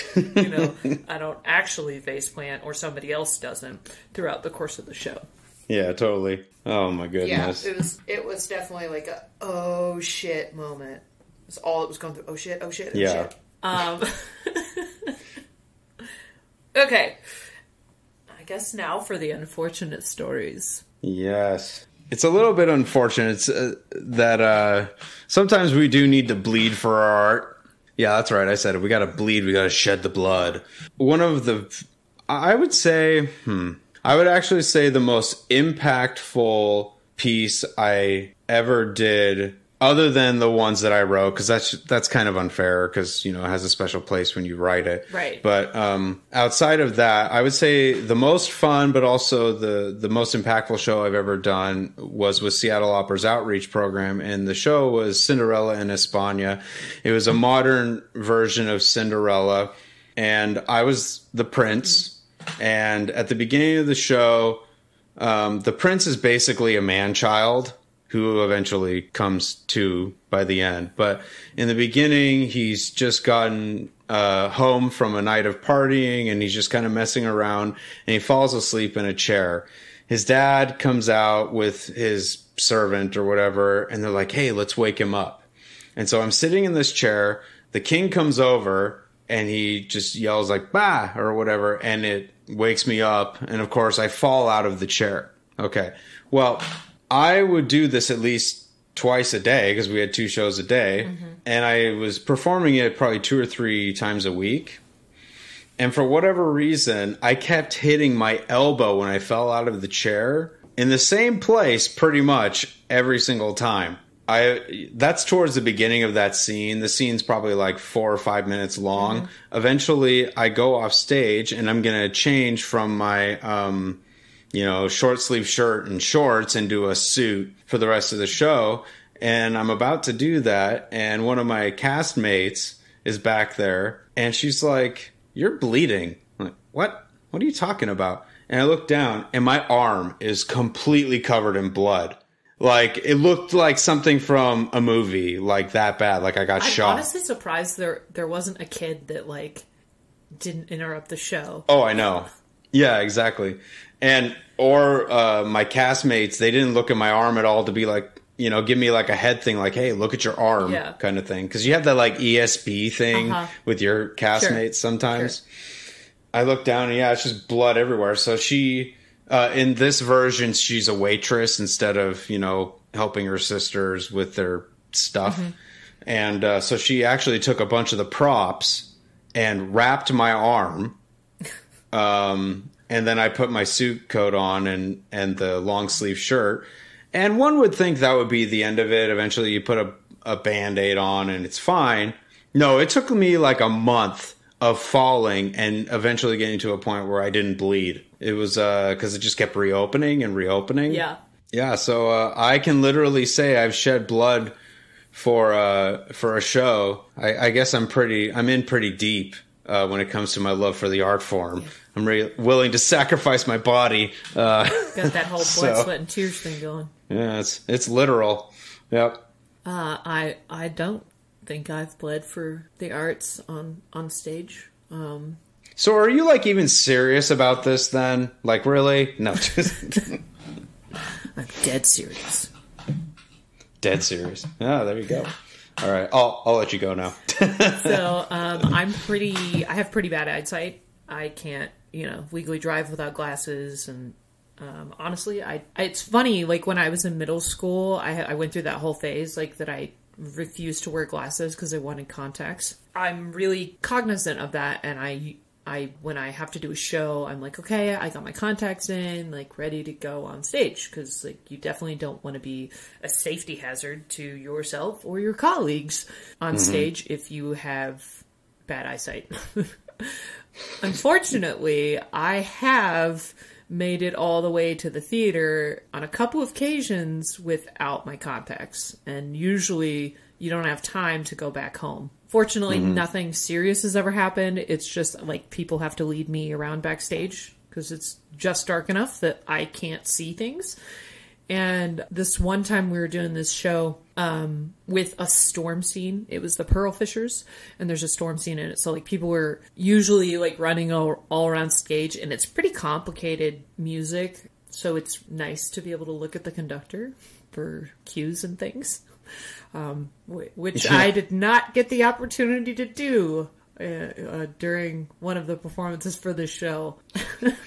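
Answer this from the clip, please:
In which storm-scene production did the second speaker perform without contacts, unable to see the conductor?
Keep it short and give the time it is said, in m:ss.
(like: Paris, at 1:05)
The Pearl Fishers, at 4:56.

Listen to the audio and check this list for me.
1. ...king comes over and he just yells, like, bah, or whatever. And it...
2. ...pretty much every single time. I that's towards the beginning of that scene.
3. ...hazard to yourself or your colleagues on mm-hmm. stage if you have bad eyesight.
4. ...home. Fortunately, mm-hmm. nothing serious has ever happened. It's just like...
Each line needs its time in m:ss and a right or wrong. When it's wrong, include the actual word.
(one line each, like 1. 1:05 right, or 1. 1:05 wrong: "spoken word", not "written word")
1. 1:27 right
2. 1:51 right
3. 4:23 right
4. 4:41 right.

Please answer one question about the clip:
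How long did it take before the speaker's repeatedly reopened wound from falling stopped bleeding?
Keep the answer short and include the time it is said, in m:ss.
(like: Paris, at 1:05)
a month, at 3:13.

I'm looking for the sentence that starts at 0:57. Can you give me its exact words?
It was a modern version of Cinderella, and I was the prince.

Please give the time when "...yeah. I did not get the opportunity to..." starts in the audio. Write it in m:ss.
5:10.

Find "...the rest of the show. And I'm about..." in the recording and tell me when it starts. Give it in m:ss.
2:07.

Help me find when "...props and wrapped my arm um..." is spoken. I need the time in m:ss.
2:58.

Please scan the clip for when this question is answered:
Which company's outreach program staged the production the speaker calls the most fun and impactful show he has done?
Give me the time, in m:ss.
0:52.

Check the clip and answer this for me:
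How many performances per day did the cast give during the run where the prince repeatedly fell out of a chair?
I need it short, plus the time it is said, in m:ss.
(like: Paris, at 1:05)
2, at 1:40.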